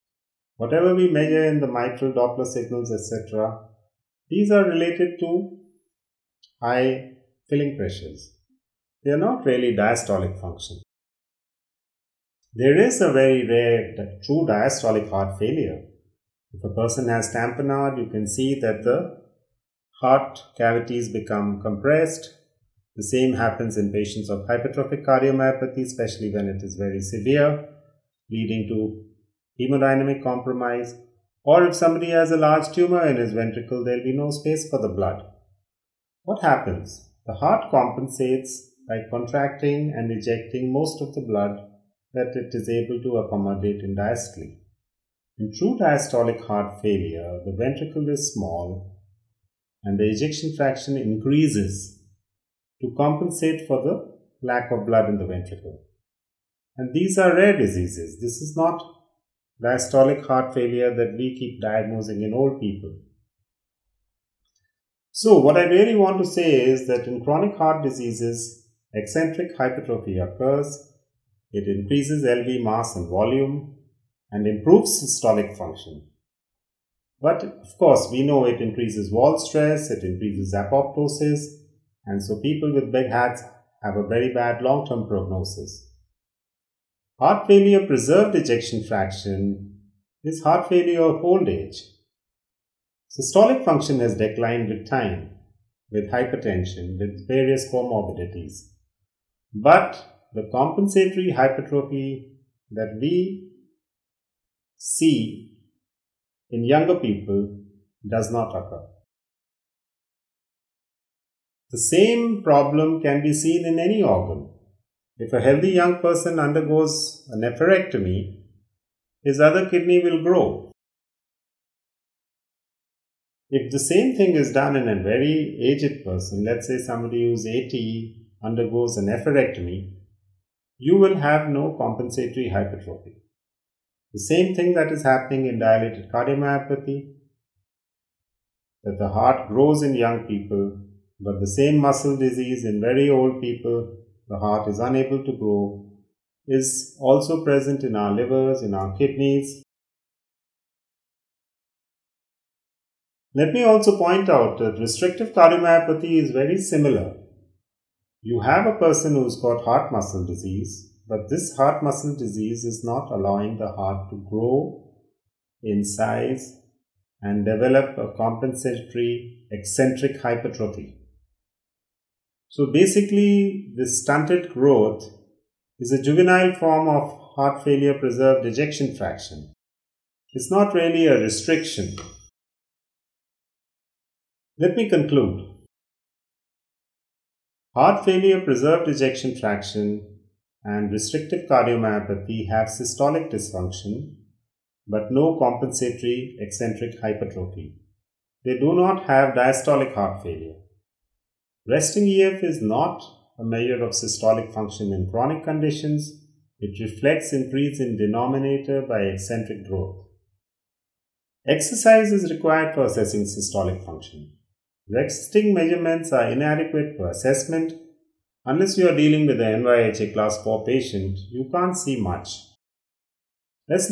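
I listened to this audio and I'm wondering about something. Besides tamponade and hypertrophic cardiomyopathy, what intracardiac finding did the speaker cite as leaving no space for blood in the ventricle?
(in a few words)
A large tumor.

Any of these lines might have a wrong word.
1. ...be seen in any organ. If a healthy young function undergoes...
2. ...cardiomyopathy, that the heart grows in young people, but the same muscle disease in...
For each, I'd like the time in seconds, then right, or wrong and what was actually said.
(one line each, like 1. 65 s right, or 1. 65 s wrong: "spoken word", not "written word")
1. 113 s wrong: "person", not "function"
2. 136 s right.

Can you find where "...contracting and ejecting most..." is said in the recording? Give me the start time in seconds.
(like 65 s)
39 s.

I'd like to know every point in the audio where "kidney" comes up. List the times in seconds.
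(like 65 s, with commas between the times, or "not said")
119 s, 148 s.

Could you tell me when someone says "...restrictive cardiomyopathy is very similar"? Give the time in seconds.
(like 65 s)
154 s.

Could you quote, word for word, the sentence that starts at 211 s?
Exercise is required for assessing systolic function.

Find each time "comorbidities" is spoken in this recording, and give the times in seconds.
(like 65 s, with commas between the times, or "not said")
97 s.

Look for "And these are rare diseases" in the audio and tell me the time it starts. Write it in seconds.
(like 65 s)
56 s.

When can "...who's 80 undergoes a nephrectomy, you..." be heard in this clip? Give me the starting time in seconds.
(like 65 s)
127 s.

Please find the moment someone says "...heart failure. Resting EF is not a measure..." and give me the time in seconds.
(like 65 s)
199 s.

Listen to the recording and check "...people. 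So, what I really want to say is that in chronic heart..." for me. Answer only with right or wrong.
right.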